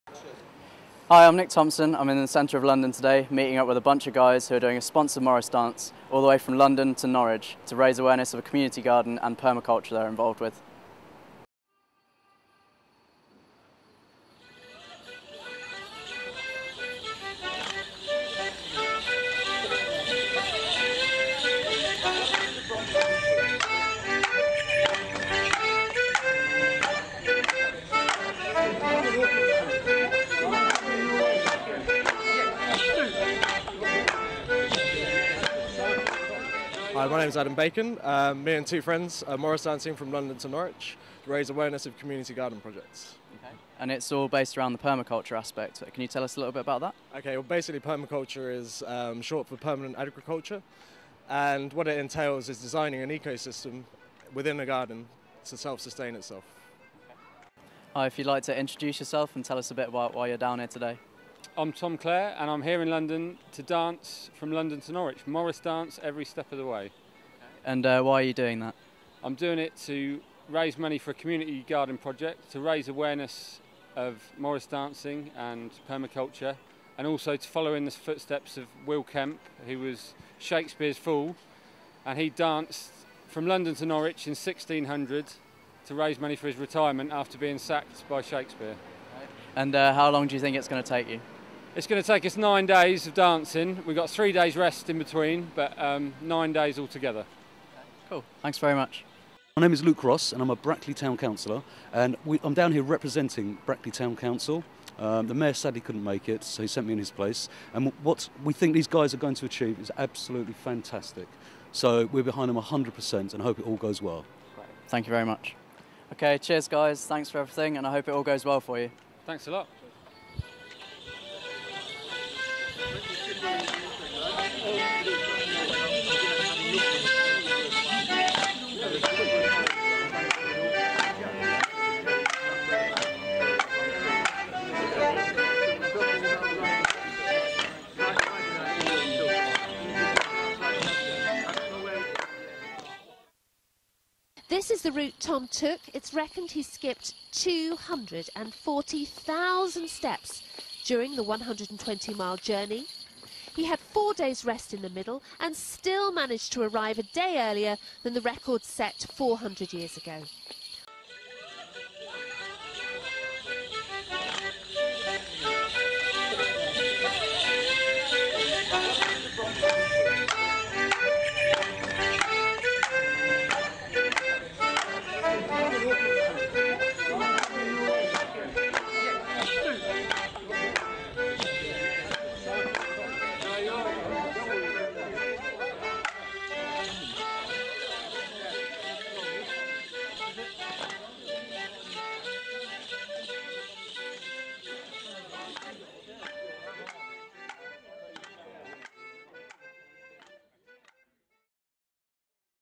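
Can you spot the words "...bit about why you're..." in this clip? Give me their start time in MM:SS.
00:59.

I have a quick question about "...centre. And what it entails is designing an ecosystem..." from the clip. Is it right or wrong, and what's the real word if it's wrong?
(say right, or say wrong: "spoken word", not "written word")
wrong: "agriculture", not "centre".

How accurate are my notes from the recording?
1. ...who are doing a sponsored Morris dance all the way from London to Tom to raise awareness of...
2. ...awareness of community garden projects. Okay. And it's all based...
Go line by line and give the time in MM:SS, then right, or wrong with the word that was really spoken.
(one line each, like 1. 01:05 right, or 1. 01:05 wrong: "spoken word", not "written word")
1. 00:04 wrong: "Norwich", not "Tom"
2. 00:41 right.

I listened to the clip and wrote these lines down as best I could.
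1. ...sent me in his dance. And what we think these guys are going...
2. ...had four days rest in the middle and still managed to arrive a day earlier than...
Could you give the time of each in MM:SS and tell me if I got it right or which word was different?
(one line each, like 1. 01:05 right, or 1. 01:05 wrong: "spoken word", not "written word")
1. 01:46 wrong: "place", not "dance"
2. 02:33 right.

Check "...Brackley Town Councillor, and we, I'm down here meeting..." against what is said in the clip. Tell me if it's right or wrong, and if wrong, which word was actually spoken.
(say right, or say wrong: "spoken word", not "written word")
wrong: "representing", not "meeting".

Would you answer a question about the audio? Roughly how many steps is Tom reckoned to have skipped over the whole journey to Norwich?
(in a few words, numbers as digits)
240,000.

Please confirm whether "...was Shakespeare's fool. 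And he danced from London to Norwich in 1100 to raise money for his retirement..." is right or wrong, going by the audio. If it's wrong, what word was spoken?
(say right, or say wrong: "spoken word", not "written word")
wrong: "1600", not "1100".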